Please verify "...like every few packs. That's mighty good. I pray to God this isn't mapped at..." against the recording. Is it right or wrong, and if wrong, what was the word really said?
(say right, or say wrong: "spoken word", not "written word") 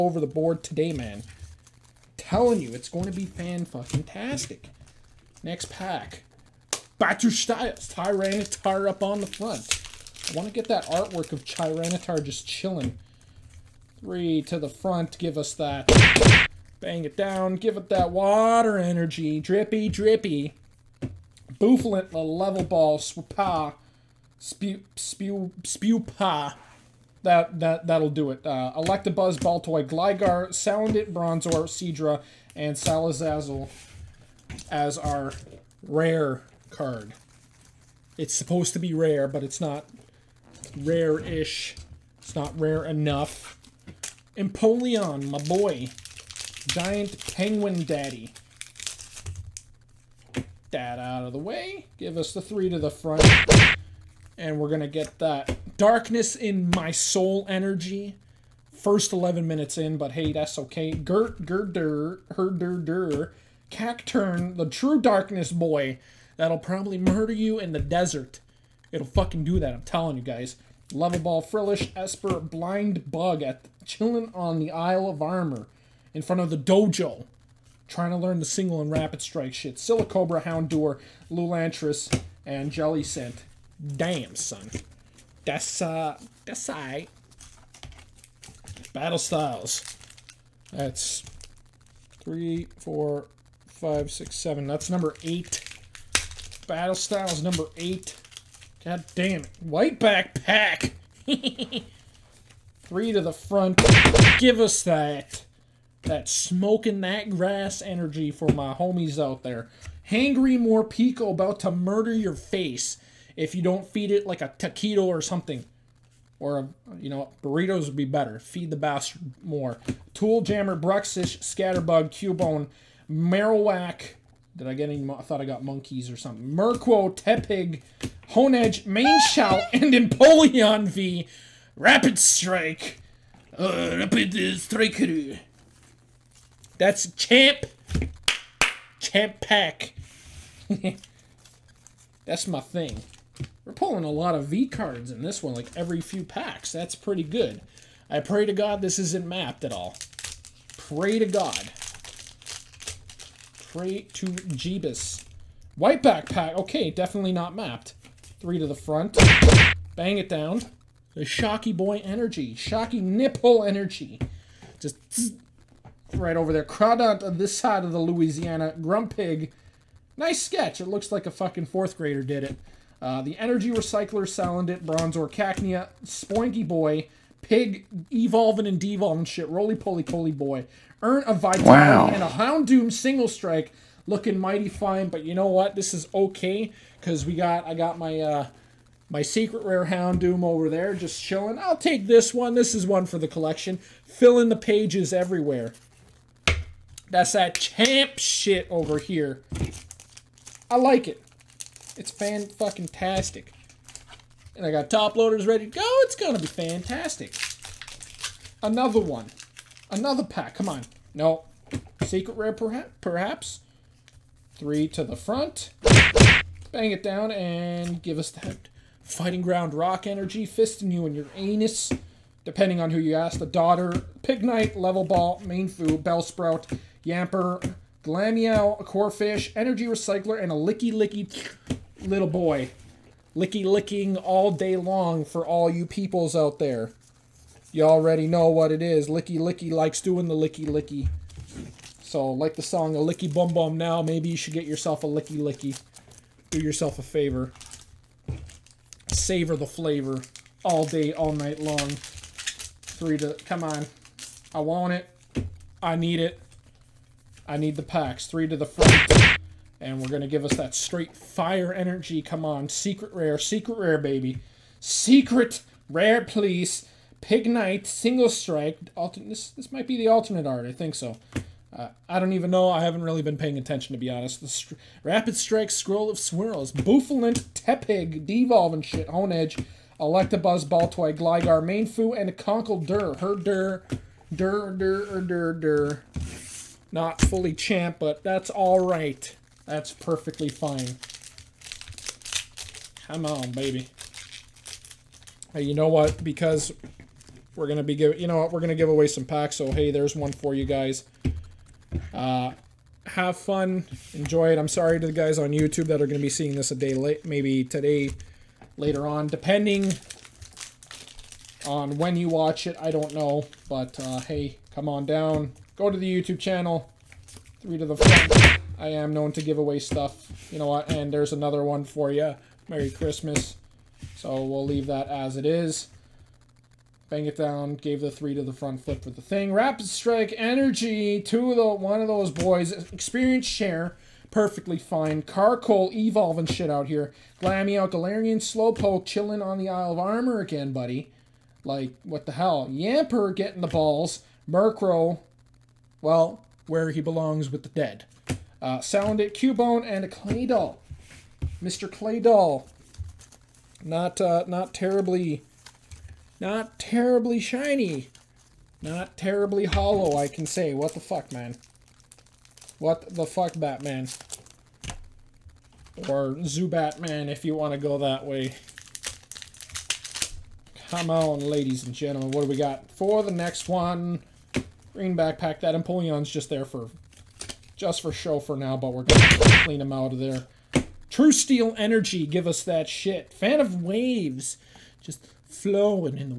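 wrong: "pretty", not "mighty".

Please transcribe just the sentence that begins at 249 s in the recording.
Savor the flavor all day, all night long.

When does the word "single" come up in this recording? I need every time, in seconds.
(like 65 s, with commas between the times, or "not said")
78 s, 182 s, 267 s.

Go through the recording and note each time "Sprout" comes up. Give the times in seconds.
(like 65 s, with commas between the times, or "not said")
226 s.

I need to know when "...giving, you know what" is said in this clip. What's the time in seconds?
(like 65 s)
297 s.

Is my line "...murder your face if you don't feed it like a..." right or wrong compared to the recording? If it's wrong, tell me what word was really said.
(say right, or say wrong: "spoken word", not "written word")
right.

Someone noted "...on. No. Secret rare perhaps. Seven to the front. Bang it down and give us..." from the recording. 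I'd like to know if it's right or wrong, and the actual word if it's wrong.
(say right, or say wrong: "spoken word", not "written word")
wrong: "Three", not "Seven".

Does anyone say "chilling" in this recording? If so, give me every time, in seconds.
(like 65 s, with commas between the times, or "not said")
12 s, 73 s, 191 s, 339 s.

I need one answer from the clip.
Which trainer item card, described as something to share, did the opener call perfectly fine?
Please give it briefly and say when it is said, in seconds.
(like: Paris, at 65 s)
Experience Share, at 332 s.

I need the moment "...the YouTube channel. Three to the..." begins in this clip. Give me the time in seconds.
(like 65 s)
315 s.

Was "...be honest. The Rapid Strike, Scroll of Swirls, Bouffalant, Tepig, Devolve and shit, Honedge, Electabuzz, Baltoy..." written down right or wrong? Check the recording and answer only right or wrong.
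right.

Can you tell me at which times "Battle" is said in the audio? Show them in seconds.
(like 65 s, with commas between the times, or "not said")
88 s, 96 s.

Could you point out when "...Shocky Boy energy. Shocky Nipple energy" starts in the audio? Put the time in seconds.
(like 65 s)
161 s.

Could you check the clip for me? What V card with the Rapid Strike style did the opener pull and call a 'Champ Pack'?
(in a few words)
Empoleon V.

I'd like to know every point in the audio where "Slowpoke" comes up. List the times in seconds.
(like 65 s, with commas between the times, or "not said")
338 s.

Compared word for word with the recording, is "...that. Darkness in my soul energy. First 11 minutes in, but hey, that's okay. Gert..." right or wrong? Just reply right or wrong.
right.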